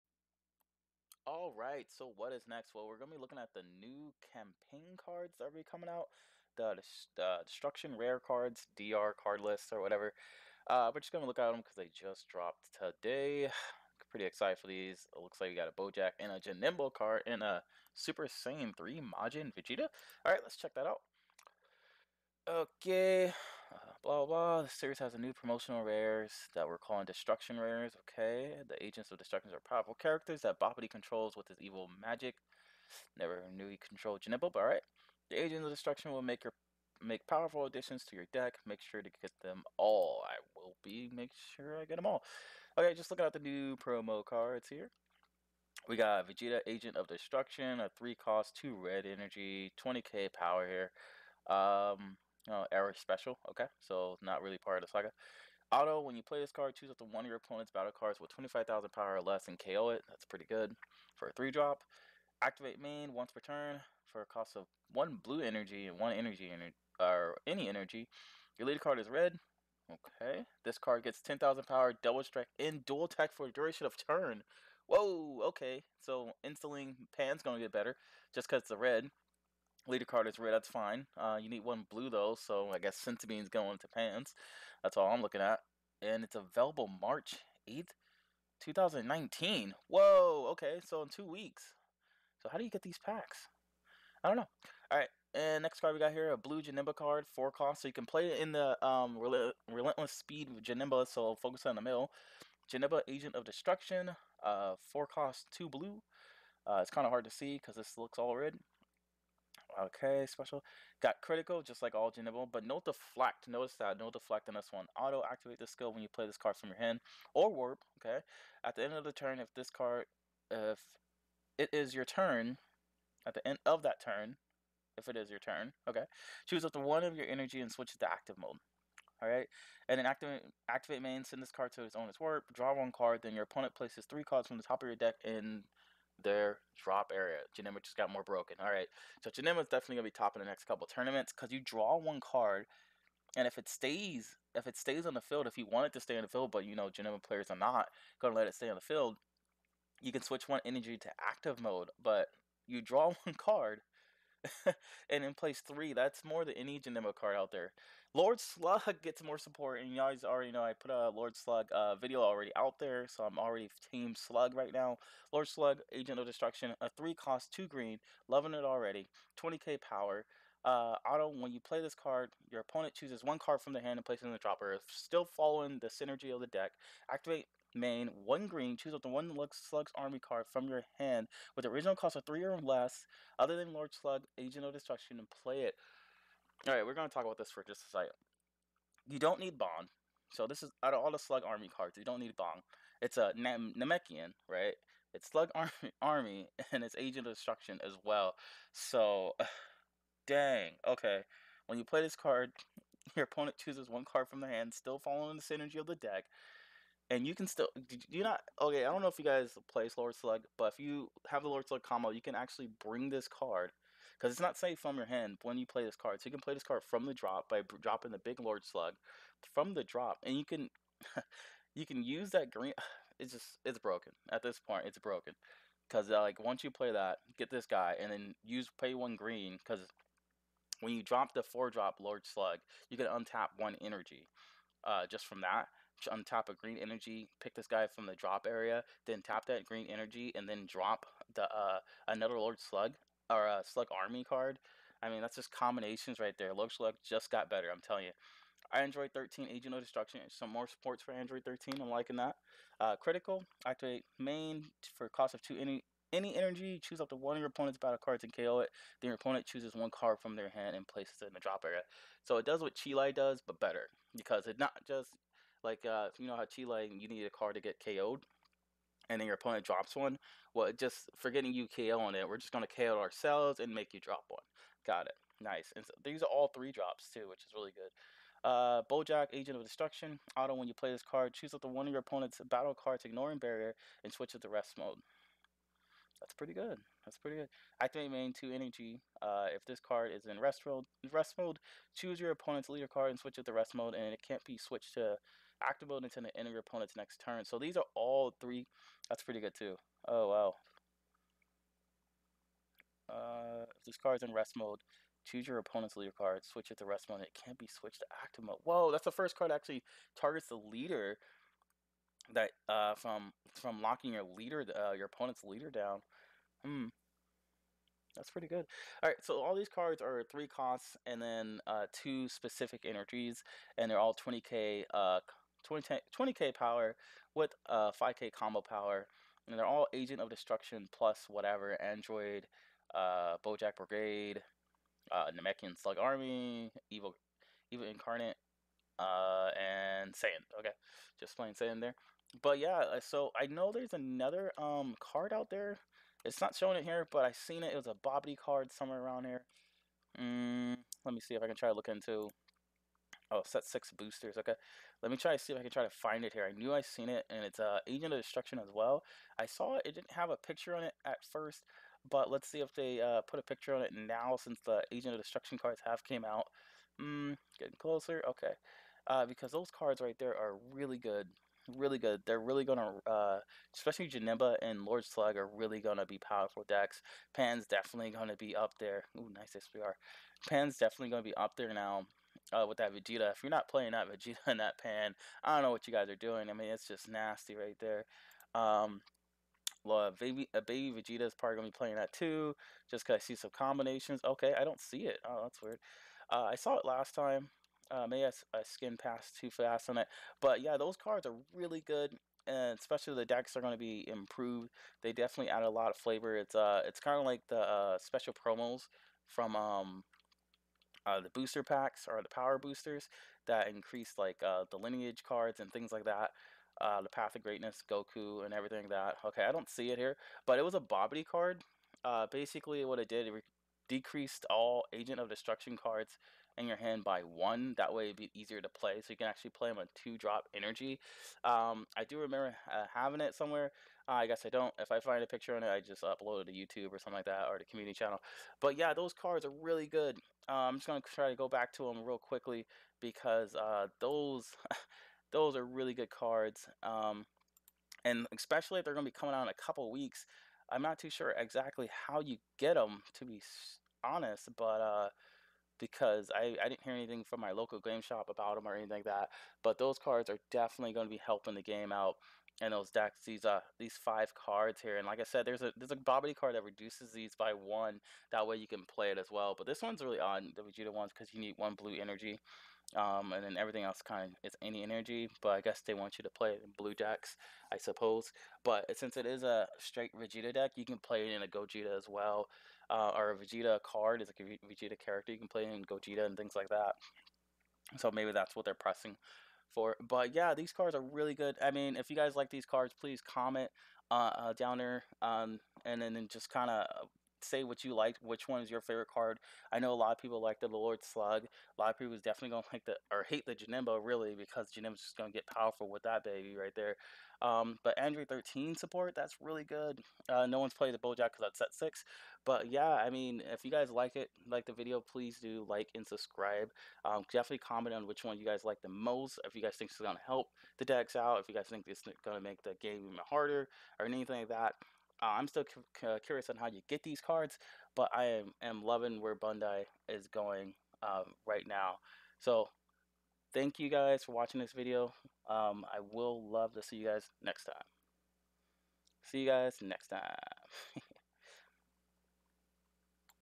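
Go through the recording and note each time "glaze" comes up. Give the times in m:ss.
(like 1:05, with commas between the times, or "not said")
not said.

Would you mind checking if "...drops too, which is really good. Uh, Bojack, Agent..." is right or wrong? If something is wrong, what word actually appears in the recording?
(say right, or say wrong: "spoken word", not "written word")
right.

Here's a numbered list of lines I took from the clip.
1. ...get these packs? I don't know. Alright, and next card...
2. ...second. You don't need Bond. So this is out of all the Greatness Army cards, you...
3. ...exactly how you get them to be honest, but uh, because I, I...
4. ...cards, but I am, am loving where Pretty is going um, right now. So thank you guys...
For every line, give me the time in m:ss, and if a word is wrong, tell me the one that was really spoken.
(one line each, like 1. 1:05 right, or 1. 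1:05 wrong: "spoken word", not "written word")
1. 1:32 right
2. 3:07 wrong: "Slug", not "Greatness"
3. 7:31 right
4. 8:47 wrong: "Bandai", not "Pretty".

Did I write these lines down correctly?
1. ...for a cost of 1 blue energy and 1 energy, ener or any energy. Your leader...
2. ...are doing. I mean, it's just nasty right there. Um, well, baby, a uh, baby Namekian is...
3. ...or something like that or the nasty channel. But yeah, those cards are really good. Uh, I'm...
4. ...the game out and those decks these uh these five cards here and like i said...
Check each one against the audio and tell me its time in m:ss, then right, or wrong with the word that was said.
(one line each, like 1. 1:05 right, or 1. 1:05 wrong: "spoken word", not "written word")
1. 1:04 right
2. 6:26 wrong: "Vegeta", not "Namekian"
3. 7:16 wrong: "community", not "nasty"
4. 7:41 right.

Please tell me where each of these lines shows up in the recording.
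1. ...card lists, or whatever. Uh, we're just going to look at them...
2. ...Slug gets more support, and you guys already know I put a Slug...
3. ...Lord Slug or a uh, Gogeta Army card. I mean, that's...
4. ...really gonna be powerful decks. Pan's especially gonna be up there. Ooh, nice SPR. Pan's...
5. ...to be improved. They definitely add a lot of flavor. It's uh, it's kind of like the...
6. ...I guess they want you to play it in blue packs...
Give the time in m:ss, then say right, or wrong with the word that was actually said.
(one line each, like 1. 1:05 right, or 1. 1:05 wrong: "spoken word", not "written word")
1. 0:09 right
2. 2:38 wrong: "Lord", not "Slug"
3. 4:02 wrong: "Slug", not "Gogeta"
4. 6:15 wrong: "definitely", not "especially"
5. 6:43 right
6. 7:55 wrong: "jacks", not "packs".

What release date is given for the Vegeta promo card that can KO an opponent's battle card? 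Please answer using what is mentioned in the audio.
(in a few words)
March 8th, 2019.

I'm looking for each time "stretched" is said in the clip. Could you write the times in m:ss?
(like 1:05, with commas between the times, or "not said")
not said.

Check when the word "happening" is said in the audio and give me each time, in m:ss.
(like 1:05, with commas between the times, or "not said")
not said.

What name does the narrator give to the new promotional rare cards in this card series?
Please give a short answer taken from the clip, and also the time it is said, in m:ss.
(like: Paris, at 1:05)
Destruction Rares, at 0:27.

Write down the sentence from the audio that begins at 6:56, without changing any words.
Uh, the Path of Greatness, Goku, and everything like that.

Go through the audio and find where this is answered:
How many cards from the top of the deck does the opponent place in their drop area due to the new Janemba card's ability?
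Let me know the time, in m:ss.
2:14.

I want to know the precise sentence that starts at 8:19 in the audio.
I know a lot of people like the Lord Slug.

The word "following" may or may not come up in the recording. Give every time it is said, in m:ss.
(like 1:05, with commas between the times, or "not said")
2:55, 3:24.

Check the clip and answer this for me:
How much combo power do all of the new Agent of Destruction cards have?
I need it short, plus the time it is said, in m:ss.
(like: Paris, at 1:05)
5k, at 5:27.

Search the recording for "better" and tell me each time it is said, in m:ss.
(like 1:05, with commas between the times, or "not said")
1:17, 4:07, 4:23.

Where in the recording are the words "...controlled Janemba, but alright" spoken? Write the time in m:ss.
0:33.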